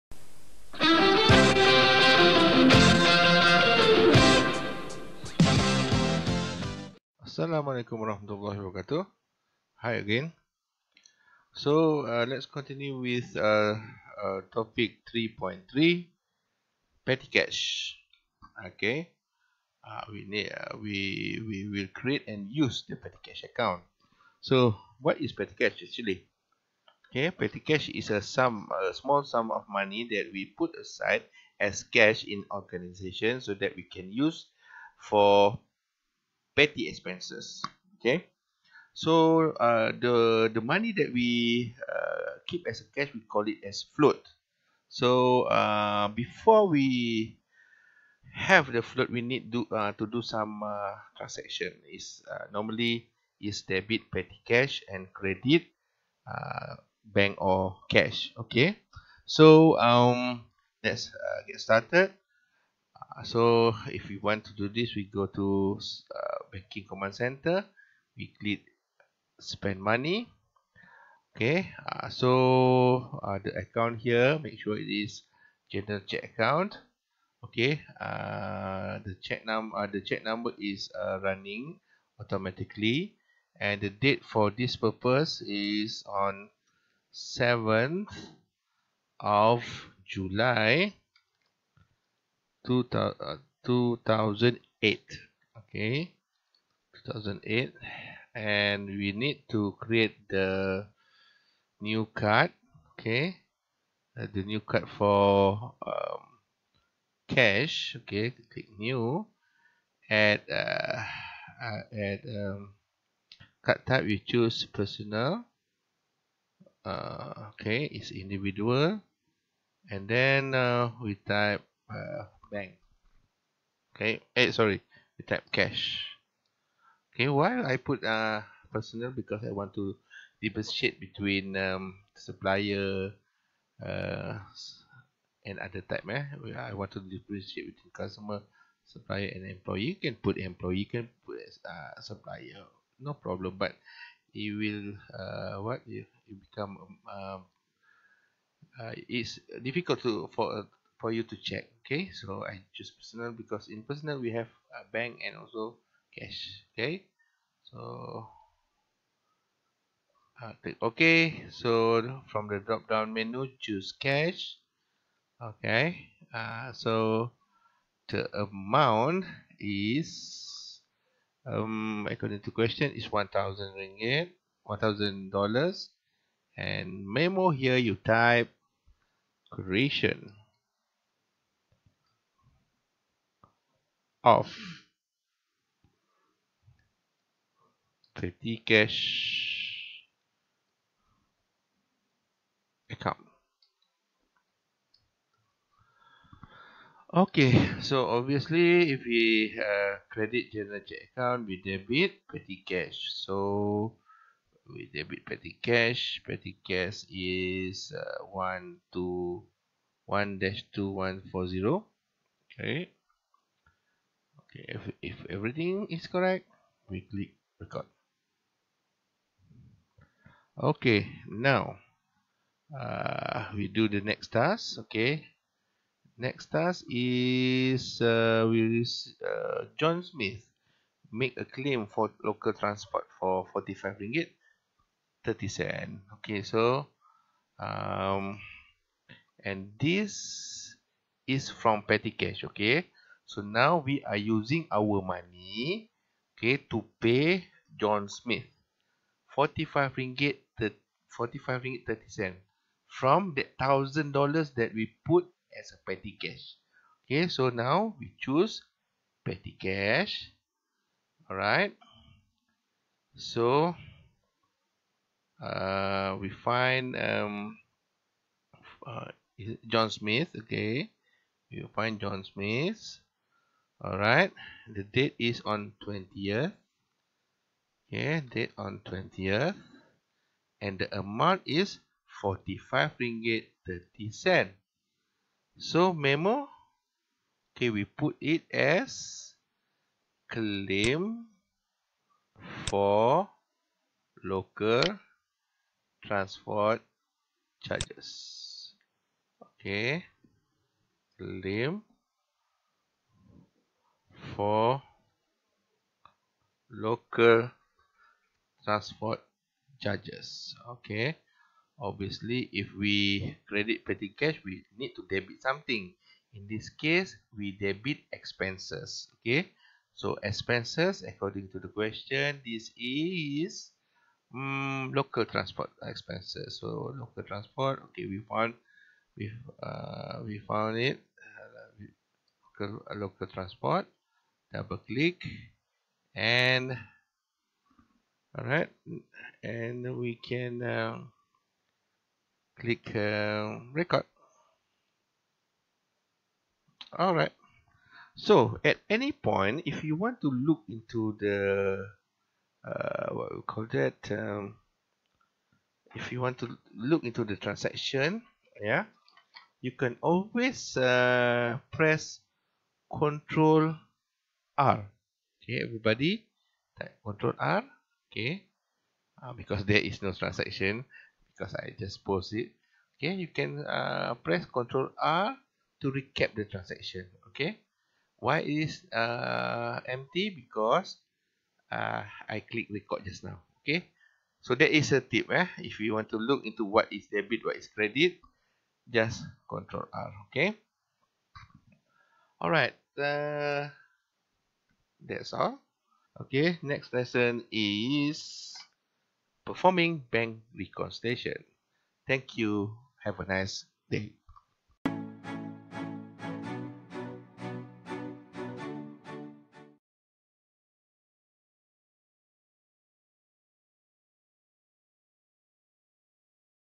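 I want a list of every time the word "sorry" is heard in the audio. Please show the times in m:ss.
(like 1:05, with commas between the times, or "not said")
2:04.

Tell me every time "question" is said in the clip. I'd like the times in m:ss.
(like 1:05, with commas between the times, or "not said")
2:52, 5:21.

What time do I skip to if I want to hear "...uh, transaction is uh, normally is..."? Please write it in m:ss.
0:50.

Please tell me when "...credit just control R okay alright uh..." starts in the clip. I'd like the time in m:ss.
6:27.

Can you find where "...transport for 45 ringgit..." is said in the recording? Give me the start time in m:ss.
3:52.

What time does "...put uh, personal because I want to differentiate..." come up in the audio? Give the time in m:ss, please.
2:07.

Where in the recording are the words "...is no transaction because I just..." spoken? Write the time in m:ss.
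6:09.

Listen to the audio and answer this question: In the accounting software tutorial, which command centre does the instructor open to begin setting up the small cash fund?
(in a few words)
Banking.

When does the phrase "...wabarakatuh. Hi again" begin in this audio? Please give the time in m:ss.
0:08.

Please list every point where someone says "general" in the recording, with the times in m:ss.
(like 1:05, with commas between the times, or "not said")
1:15, 3:20.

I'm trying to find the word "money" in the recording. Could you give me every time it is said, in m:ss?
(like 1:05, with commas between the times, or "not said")
0:29, 0:40, 1:09, 4:04.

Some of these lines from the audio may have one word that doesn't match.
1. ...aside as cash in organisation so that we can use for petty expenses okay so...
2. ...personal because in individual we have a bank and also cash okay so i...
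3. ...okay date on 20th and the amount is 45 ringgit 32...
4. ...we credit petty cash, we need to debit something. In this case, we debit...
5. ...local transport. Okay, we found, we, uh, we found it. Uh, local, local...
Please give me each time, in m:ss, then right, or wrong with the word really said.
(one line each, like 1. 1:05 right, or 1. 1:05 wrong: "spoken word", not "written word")
1. 0:30 right
2. 2:32 wrong: "personal", not "individual"
3. 4:37 wrong: "30", not "32"
4. 5:12 right
5. 5:26 right.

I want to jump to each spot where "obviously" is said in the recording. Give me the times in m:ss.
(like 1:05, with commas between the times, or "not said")
3:18, 5:11.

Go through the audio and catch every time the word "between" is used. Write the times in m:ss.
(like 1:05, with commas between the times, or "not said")
2:10, 2:17.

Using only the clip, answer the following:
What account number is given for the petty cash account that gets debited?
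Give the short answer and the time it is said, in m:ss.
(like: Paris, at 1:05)
1-2140, at 3:28.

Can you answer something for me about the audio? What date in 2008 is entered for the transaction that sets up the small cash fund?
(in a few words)
7th of July 2008.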